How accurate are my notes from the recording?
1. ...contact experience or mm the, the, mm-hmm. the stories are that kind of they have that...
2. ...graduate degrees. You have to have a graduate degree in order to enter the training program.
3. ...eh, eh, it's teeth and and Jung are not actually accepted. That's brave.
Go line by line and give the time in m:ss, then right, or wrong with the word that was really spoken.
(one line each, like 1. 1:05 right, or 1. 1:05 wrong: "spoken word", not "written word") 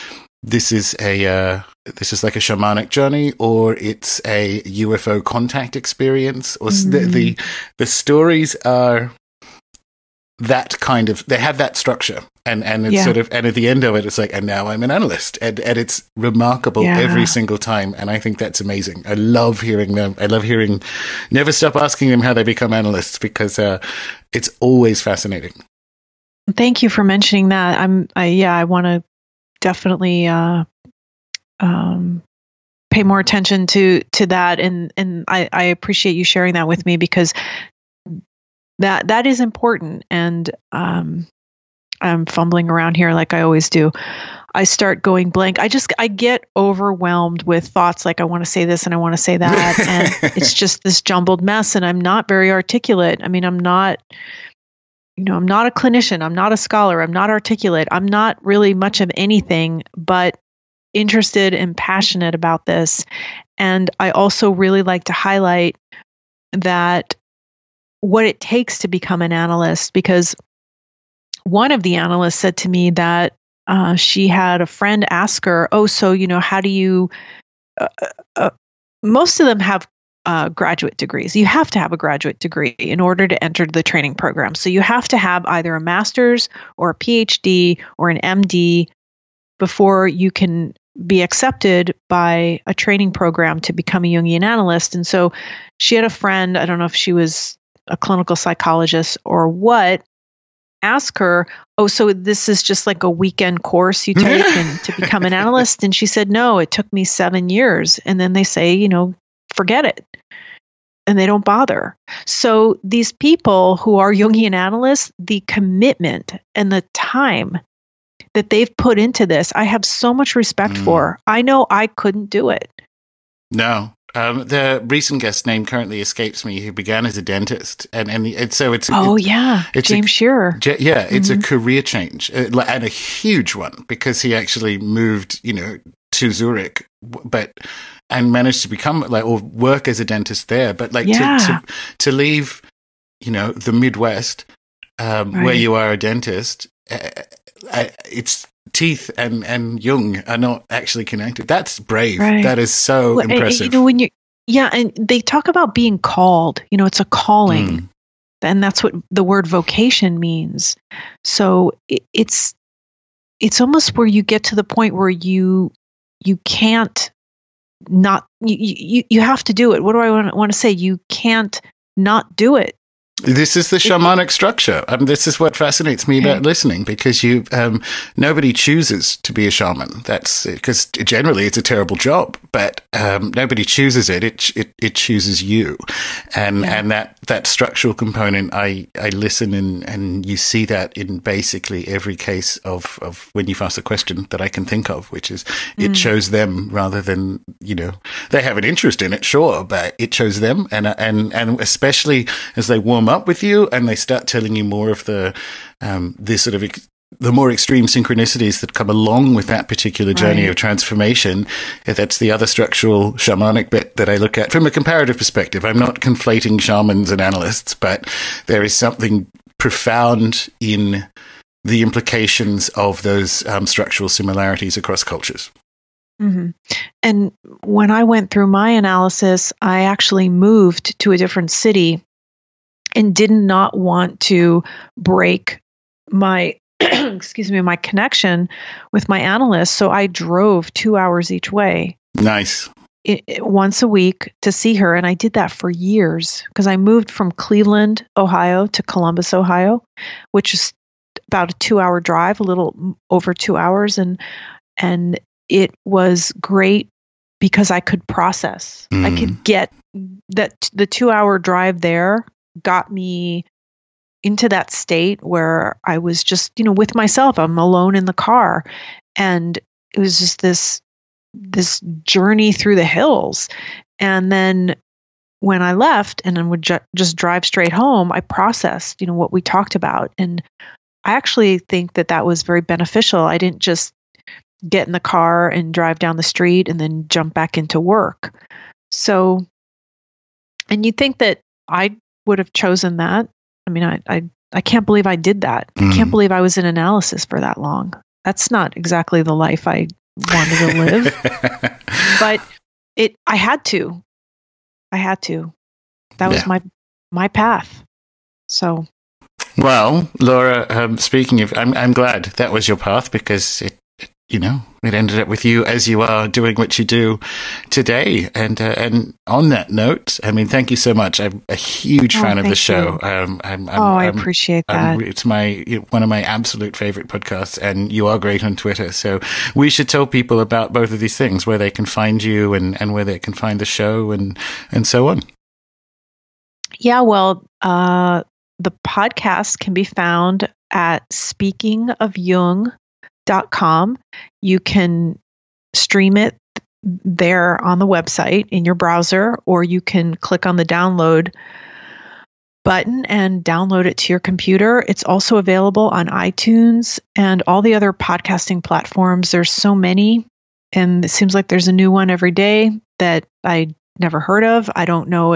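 1. 0:05 right
2. 1:20 right
3. 2:27 wrong: "connected", not "accepted".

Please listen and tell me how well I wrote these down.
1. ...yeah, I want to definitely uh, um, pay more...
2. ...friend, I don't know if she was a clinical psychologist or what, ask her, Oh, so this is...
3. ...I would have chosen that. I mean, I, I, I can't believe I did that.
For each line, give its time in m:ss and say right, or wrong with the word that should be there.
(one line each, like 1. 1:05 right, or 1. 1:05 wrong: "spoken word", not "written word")
1. 0:28 right
2. 1:36 right
3. 4:51 right.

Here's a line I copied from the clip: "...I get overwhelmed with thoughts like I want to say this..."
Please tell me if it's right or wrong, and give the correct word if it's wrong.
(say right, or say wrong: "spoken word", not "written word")
right.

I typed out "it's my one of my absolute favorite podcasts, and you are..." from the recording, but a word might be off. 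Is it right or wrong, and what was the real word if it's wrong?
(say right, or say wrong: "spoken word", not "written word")
right.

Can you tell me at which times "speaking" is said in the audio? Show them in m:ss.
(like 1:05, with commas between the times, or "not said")
5:10, 5:41.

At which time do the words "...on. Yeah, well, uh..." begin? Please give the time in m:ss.
5:35.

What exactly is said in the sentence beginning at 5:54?
It's also available on iTunes and all the other podcasting platforms.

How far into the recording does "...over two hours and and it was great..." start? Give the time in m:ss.
4:13.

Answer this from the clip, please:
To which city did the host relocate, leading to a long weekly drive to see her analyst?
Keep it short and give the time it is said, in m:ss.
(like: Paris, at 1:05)
Columbus, Ohio, at 4:08.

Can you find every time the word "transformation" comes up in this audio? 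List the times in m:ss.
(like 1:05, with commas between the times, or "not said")
3:30.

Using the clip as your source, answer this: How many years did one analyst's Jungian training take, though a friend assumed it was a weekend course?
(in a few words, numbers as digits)
7 years.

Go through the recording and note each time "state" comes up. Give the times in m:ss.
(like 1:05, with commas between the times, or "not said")
4:24.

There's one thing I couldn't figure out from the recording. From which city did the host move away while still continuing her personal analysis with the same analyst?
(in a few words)
Cleveland, Ohio.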